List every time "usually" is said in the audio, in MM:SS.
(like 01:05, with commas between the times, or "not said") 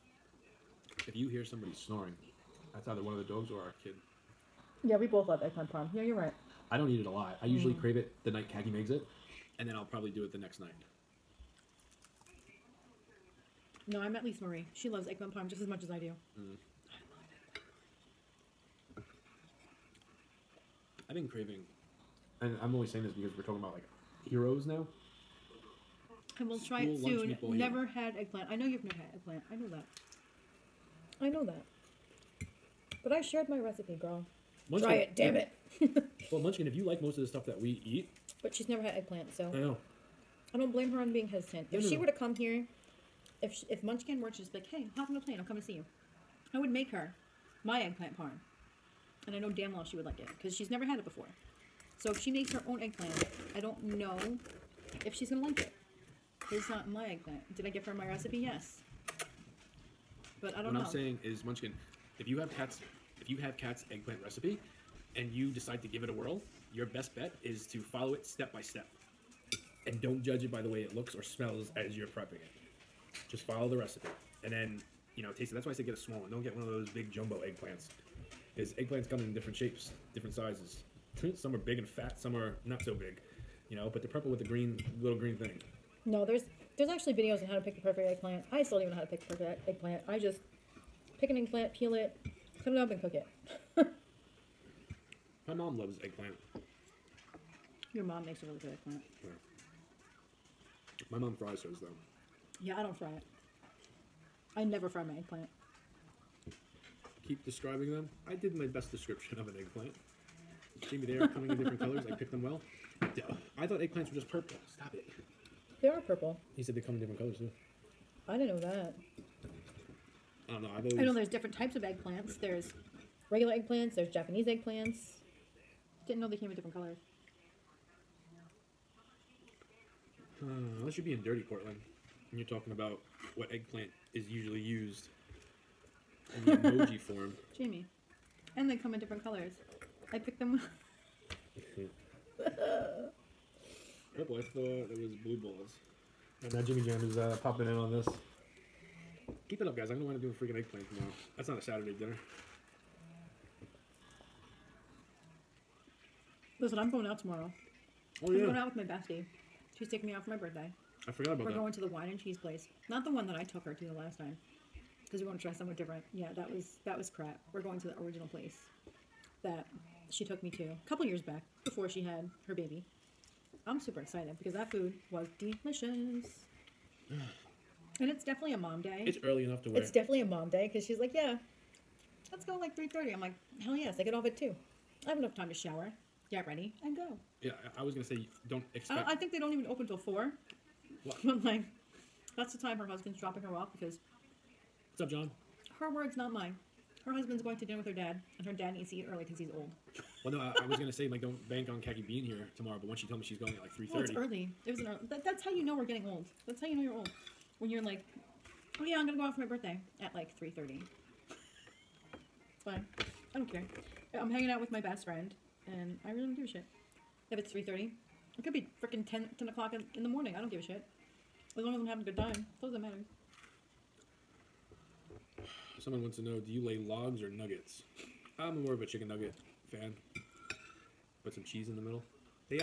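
00:07, 02:14.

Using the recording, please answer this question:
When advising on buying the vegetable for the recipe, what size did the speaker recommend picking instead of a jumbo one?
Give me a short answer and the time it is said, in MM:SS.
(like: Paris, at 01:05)
A small one, at 01:15.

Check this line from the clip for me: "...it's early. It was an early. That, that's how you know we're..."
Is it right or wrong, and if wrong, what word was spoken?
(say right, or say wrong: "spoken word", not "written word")
right.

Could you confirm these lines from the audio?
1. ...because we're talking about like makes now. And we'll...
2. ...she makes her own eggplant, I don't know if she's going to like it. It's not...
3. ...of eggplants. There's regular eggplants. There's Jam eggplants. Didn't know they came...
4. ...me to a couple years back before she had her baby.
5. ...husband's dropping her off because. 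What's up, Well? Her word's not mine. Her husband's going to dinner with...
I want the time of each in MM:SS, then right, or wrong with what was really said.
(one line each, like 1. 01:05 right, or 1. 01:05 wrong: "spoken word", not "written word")
1. 00:23 wrong: "heroes", not "makes"
2. 00:52 right
3. 02:01 wrong: "Japanese", not "Jam"
4. 02:50 right
5. 03:12 wrong: "John", not "Well".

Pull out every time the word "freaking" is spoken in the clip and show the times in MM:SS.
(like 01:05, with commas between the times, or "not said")
02:30, 03:38.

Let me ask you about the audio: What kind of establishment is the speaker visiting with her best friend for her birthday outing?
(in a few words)
Wine and cheese place.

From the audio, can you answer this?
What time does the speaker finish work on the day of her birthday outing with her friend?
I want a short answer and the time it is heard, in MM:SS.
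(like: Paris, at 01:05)
2, at 03:03.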